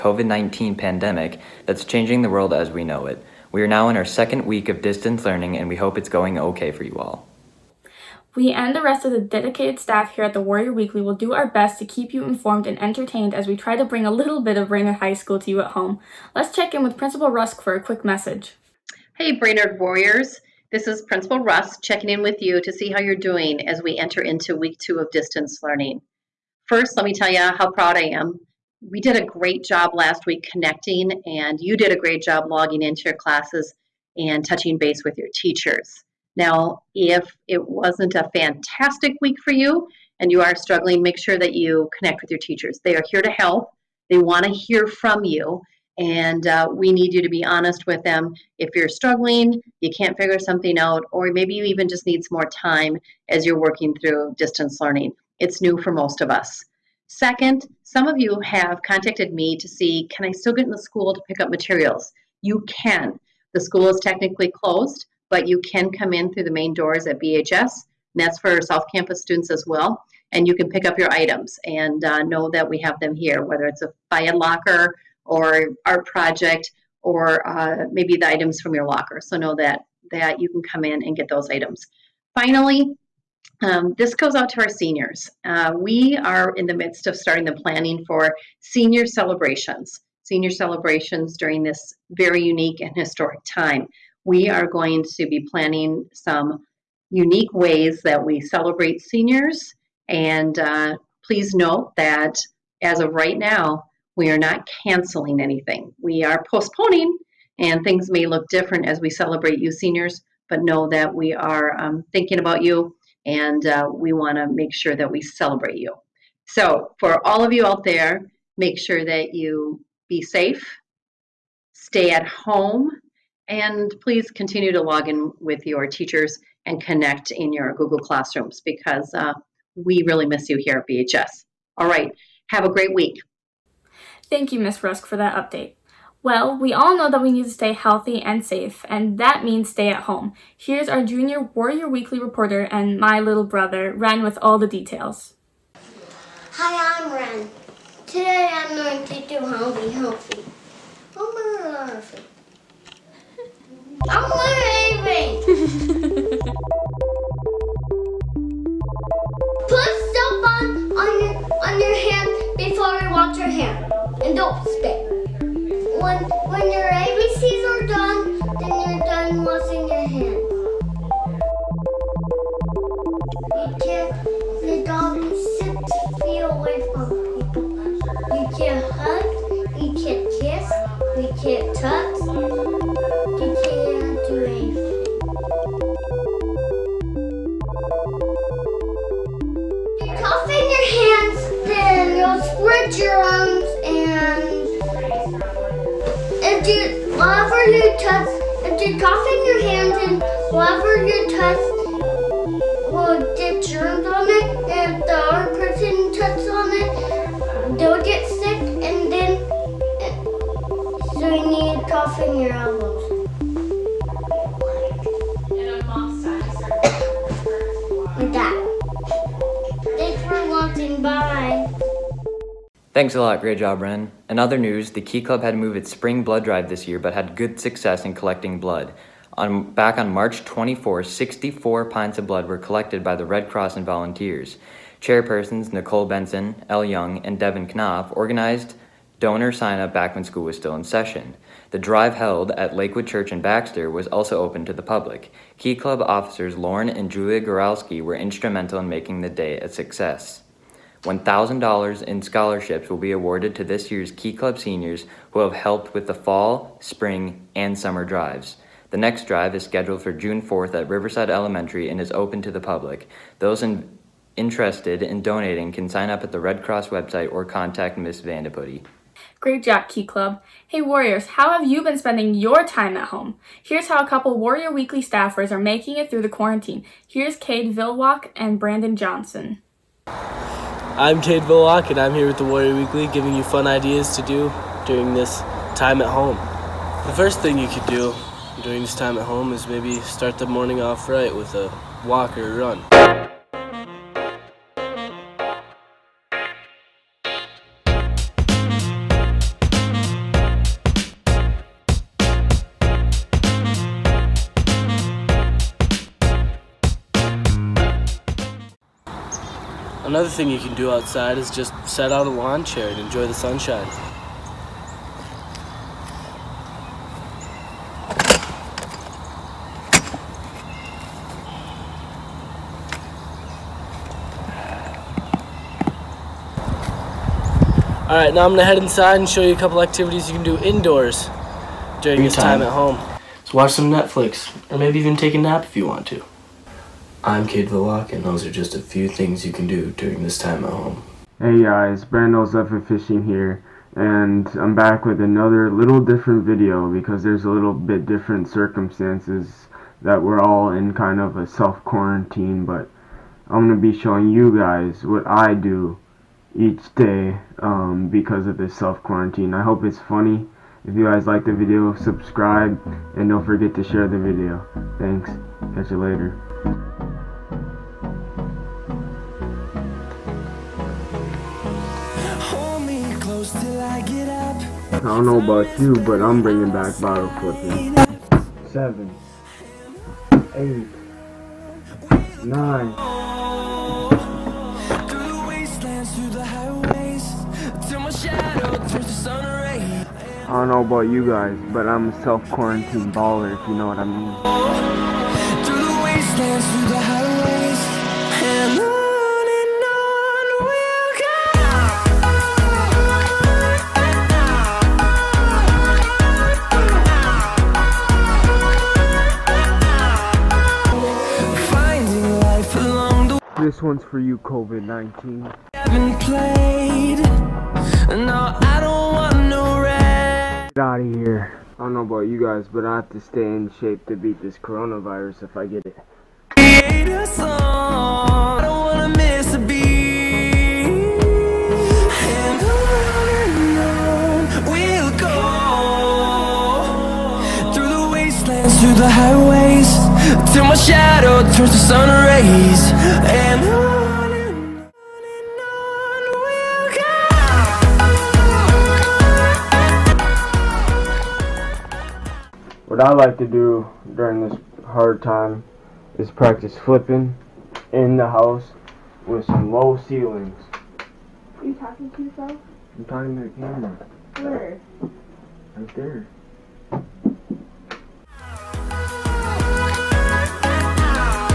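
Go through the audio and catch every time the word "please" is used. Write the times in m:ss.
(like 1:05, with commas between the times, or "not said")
1:41, 2:04.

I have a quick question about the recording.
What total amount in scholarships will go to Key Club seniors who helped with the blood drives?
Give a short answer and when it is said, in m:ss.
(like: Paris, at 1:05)
$1,000, at 4:11.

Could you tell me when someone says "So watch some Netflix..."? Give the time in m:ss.
5:33.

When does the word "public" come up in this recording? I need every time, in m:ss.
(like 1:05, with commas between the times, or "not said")
4:04, 4:22.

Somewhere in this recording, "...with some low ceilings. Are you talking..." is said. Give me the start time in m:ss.
7:39.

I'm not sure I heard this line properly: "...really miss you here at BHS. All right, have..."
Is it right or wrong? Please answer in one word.
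right.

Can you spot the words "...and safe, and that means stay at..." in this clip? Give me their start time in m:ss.
2:18.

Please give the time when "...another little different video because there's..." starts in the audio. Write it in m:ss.
5:45.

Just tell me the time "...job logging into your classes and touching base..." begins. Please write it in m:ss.
0:32.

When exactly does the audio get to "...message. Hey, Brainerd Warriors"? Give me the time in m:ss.
0:18.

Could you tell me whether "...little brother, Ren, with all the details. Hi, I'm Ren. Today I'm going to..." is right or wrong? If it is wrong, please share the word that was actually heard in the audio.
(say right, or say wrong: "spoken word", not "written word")
right.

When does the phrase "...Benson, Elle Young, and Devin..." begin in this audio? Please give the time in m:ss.
3:56.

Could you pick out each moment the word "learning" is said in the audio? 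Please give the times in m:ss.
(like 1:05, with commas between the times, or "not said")
0:05, 0:25, 0:54.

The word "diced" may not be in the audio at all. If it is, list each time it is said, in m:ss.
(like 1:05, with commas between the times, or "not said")
not said.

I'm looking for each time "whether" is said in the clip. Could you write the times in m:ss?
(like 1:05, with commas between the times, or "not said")
1:13.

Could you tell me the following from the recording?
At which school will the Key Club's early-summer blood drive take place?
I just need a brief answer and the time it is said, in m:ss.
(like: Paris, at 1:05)
Riverside Elementary, at 4:20.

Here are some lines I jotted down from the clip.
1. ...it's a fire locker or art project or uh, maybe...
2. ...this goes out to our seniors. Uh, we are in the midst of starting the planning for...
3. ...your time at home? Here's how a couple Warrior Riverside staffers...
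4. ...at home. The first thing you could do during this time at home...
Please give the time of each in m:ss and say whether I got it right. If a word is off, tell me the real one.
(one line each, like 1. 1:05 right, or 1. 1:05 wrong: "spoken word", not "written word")
1. 1:13 right
2. 1:23 right
3. 4:32 wrong: "Weekly", not "Riverside"
4. 4:46 right.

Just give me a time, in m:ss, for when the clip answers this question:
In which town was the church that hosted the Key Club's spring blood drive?
4:03.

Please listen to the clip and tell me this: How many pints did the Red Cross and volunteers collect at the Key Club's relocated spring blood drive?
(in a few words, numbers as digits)
64.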